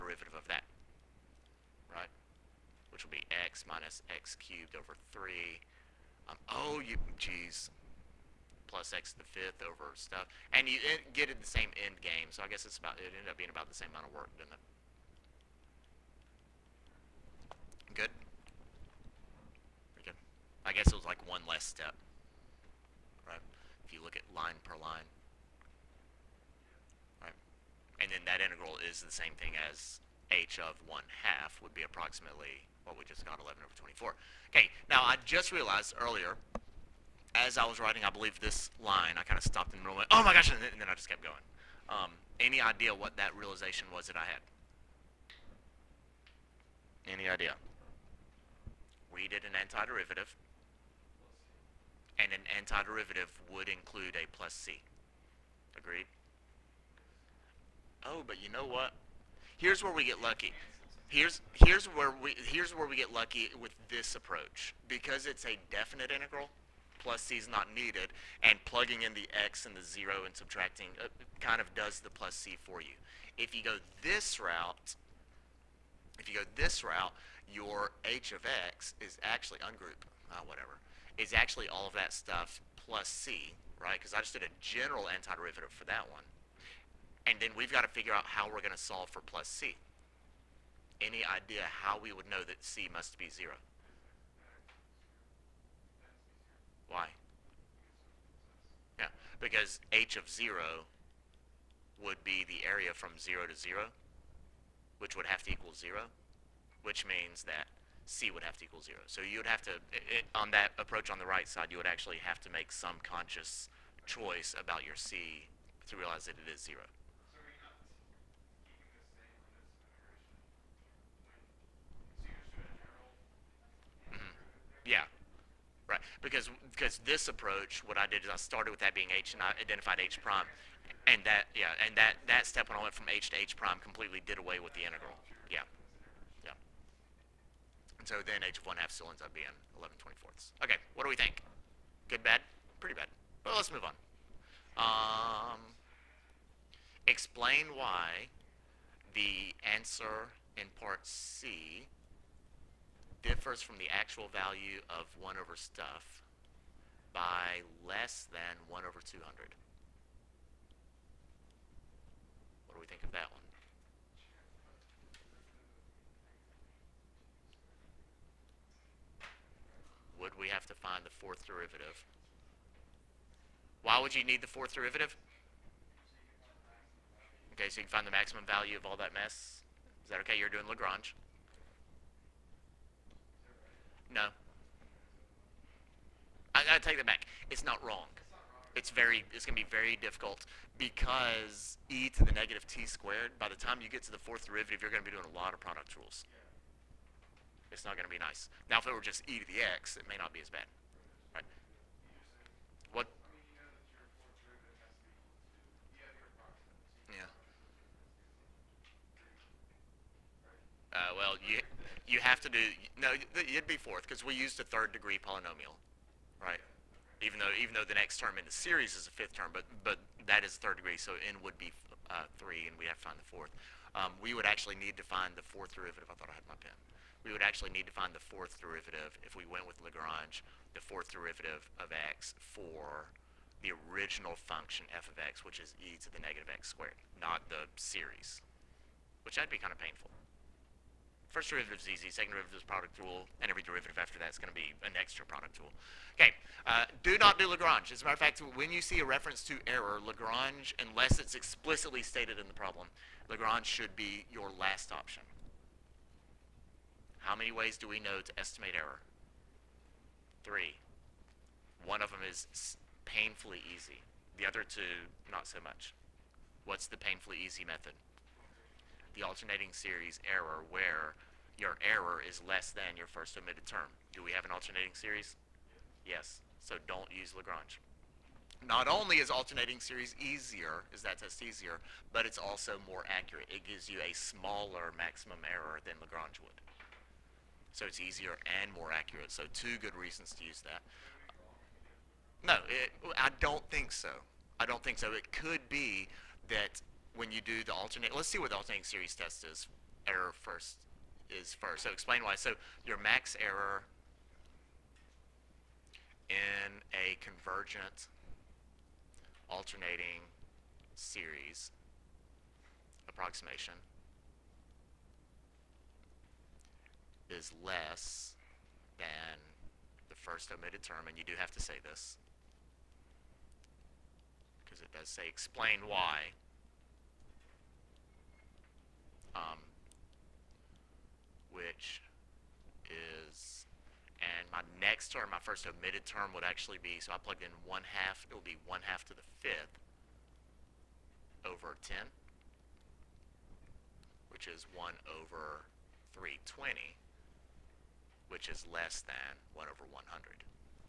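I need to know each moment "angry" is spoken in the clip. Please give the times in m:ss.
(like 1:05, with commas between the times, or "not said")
not said.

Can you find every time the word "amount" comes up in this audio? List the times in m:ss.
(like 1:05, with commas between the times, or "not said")
0:13.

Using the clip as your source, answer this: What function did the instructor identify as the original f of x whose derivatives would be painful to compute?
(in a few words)
e to the negative x squared.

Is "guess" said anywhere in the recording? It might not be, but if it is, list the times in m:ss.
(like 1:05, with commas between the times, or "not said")
0:12, 0:20.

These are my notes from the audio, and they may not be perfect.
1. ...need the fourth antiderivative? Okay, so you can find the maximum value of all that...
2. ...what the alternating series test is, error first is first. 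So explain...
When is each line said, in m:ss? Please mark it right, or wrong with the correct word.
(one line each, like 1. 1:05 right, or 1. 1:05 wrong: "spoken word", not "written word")
1. 2:54 wrong: "derivative", not "antiderivative"
2. 4:58 right.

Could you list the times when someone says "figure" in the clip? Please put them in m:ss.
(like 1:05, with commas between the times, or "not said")
1:27.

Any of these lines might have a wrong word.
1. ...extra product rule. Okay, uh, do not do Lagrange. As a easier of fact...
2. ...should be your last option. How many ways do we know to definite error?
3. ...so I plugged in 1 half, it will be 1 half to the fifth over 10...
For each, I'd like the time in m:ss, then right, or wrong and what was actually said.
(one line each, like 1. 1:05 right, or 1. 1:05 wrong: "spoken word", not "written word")
1. 4:04 wrong: "matter", not "easier"
2. 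4:13 wrong: "estimate", not "definite"
3. 5:36 right.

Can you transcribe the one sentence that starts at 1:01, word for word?
Here's here's where we here's where we get lucky with this approach because it's a definite integral.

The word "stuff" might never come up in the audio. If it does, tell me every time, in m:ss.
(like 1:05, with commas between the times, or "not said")
0:09, 1:22, 2:35.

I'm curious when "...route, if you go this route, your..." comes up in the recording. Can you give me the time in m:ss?
1:14.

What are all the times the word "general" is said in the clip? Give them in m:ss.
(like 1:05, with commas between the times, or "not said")
1:24.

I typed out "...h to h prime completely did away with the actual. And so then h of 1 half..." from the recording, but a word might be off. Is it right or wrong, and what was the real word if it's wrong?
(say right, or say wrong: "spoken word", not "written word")
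wrong: "integral", not "actual".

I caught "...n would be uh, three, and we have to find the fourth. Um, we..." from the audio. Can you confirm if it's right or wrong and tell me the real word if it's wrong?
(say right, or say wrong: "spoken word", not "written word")
right.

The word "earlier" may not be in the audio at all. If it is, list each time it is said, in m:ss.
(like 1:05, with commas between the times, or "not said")
0:35.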